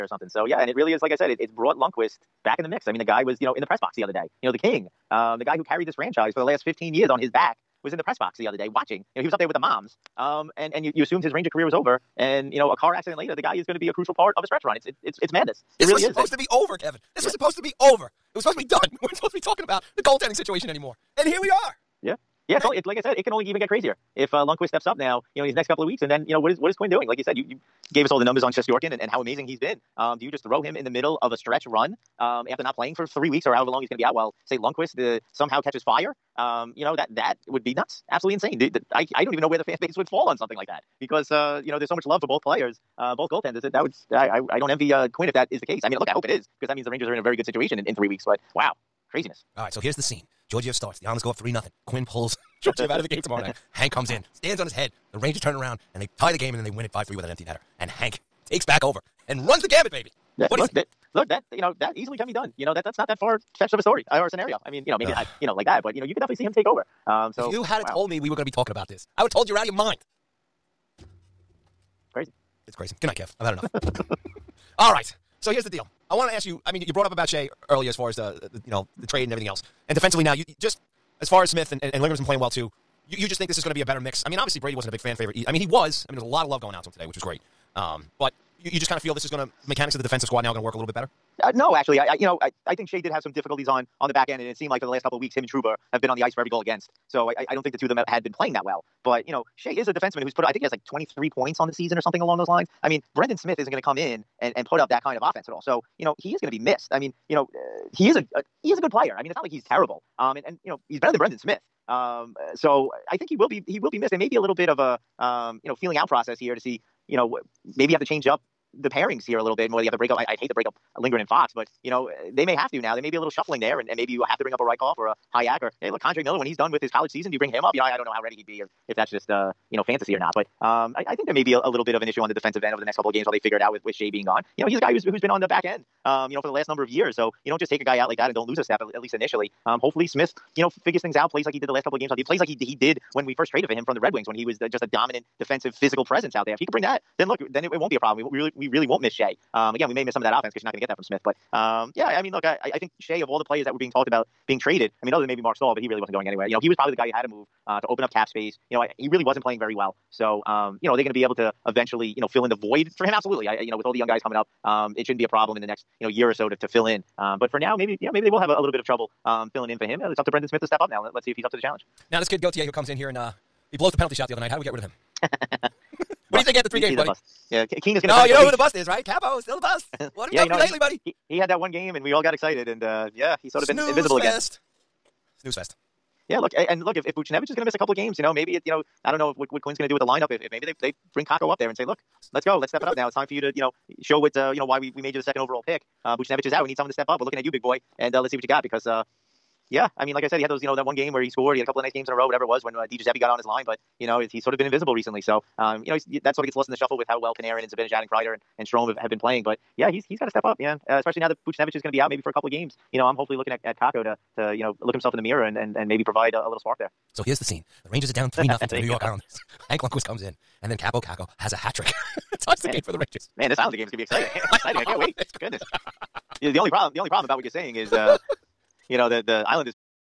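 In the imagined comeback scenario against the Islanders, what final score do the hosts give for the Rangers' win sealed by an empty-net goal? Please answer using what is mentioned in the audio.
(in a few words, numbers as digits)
5-3.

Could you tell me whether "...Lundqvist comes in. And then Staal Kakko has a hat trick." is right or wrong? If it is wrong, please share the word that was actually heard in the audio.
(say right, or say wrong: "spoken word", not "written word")
wrong: "Kaapo", not "Staal".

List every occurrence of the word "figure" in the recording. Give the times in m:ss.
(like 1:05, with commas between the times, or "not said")
2:13, 2:20.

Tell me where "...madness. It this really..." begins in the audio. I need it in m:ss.
0:15.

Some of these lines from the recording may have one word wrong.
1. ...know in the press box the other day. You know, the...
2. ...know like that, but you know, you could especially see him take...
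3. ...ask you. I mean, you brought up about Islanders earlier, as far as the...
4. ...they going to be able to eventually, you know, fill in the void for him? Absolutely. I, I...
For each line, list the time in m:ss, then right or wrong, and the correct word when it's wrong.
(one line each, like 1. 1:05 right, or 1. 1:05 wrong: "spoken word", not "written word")
1. 0:03 right
2. 1:05 wrong: "definitely", not "especially"
3. 1:16 wrong: "Skjei", not "Islanders"
4. 2:40 right.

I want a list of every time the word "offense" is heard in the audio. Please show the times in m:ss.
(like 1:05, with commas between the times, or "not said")
1:45, 2:30.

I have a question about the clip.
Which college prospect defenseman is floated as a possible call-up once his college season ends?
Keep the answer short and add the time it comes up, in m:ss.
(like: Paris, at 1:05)
K'Andre Miller, at 2:06.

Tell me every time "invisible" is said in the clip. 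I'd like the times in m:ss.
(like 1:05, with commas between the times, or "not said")
3:03, 3:24.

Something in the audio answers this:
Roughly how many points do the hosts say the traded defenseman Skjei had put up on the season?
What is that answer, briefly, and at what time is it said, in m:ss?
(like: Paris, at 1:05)
23, at 1:40.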